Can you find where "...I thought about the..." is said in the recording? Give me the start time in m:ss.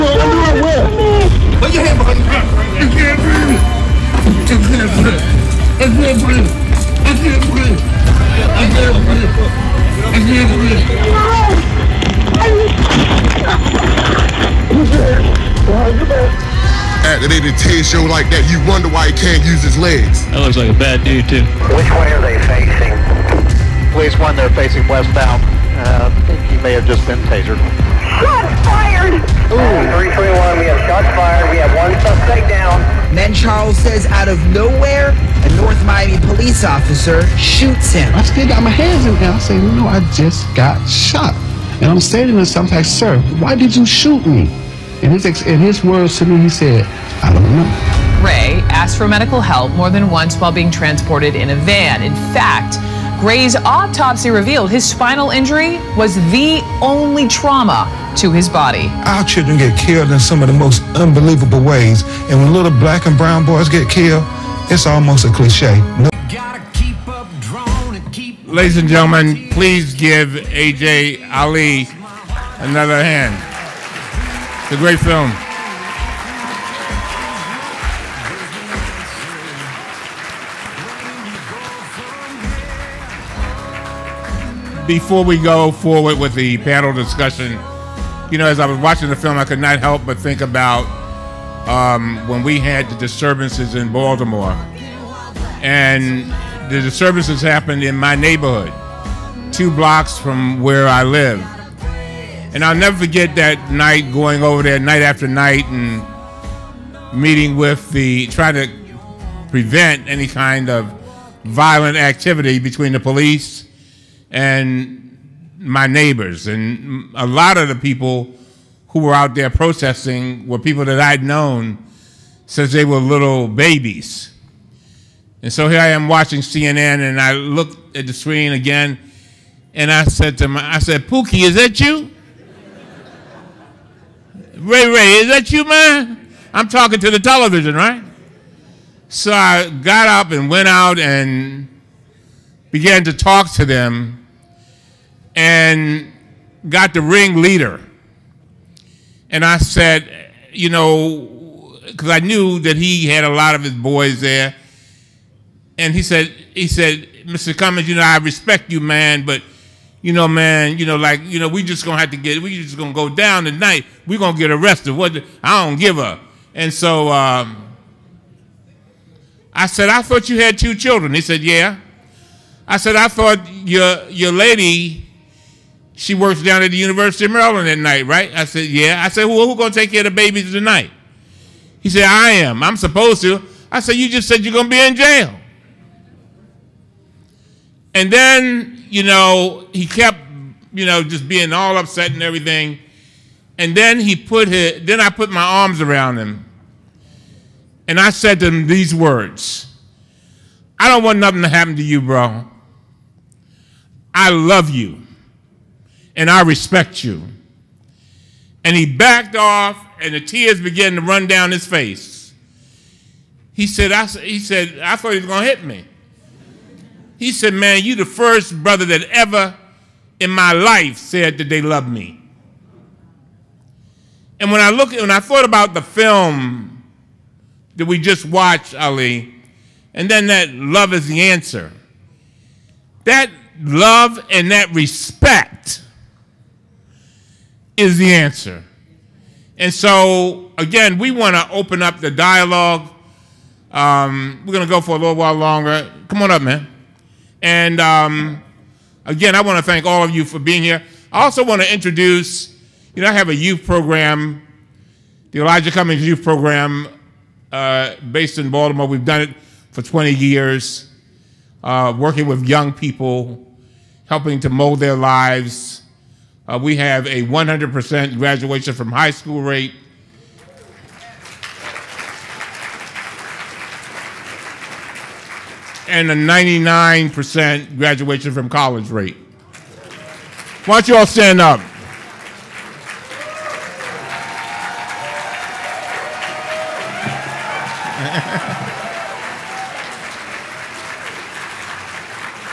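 3:45.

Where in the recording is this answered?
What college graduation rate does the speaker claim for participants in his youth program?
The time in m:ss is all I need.
4:36.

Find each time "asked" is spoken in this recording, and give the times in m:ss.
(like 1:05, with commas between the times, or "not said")
0:48.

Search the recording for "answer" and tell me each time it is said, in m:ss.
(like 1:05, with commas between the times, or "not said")
3:51, 3:58.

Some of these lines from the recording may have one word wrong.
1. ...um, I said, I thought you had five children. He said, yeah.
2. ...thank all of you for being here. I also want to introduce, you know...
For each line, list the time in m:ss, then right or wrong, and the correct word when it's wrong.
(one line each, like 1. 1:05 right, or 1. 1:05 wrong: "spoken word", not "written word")
1. 2:47 wrong: "two", not "five"
2. 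4:09 right.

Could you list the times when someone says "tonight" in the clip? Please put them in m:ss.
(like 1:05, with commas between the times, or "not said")
2:43, 3:00.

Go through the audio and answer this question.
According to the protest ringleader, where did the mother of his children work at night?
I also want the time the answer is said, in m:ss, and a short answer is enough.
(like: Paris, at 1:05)
University of Maryland, at 2:56.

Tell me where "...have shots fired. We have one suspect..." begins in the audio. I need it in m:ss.
0:30.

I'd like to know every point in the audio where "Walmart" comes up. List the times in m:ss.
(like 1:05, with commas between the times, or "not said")
not said.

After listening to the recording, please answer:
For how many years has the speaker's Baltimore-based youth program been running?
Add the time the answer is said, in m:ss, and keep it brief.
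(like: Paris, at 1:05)
20 years, at 4:19.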